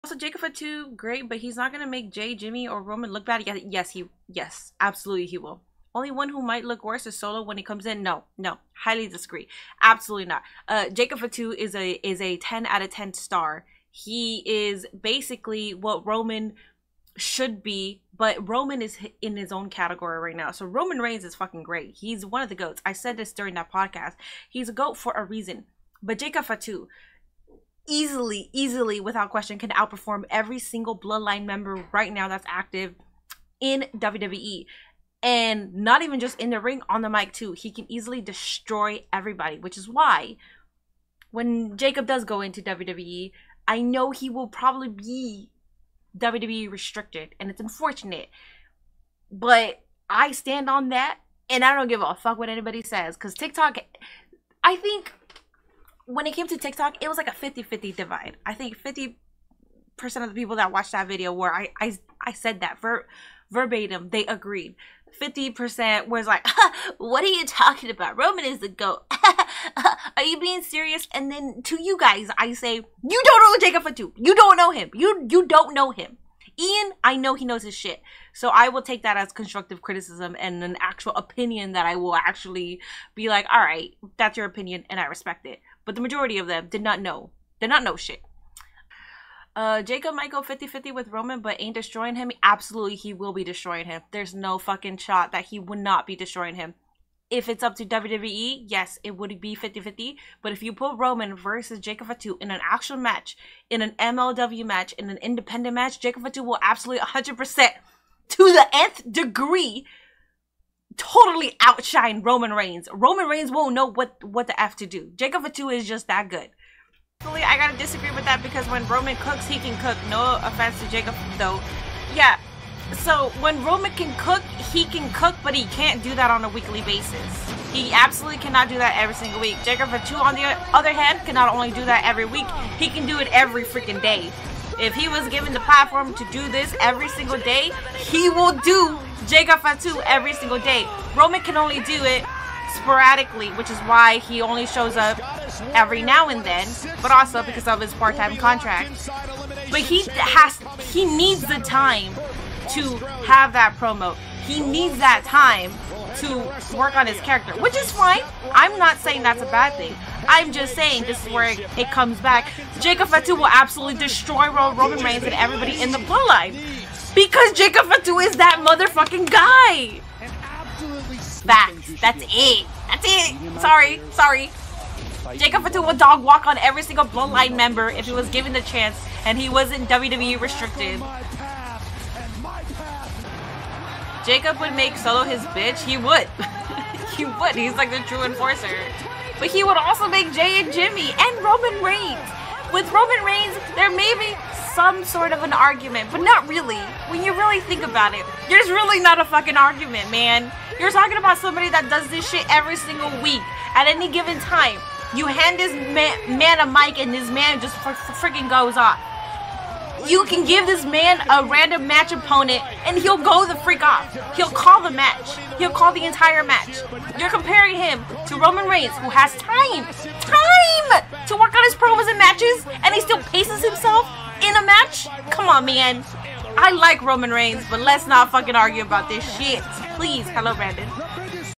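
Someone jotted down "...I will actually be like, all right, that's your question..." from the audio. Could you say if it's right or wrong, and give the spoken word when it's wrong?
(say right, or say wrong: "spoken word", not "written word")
wrong: "opinion", not "question".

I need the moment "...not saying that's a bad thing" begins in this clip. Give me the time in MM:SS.
02:38.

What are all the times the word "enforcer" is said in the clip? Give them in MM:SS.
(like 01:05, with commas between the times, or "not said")
03:08.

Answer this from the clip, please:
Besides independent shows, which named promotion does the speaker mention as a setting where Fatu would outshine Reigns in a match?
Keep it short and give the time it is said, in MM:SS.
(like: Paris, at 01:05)
MLW, at 01:43.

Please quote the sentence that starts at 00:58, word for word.
I think 50% of the people that watched that video were I I, I said that ver- verbatim.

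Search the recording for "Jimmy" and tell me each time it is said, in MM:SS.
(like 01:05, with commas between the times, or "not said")
00:02, 03:10.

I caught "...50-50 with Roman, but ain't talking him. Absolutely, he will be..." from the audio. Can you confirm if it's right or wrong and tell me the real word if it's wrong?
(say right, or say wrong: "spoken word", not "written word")
wrong: "destroying", not "talking".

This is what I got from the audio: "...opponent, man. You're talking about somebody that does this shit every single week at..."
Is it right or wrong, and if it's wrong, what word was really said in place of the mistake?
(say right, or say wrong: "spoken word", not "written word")
wrong: "argument", not "opponent".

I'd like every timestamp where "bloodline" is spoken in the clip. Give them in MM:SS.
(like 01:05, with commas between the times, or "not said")
00:30, 02:45, 02:57.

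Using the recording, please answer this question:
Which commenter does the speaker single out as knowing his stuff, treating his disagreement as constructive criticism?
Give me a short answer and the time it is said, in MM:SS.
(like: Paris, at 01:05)
Ian, at 01:16.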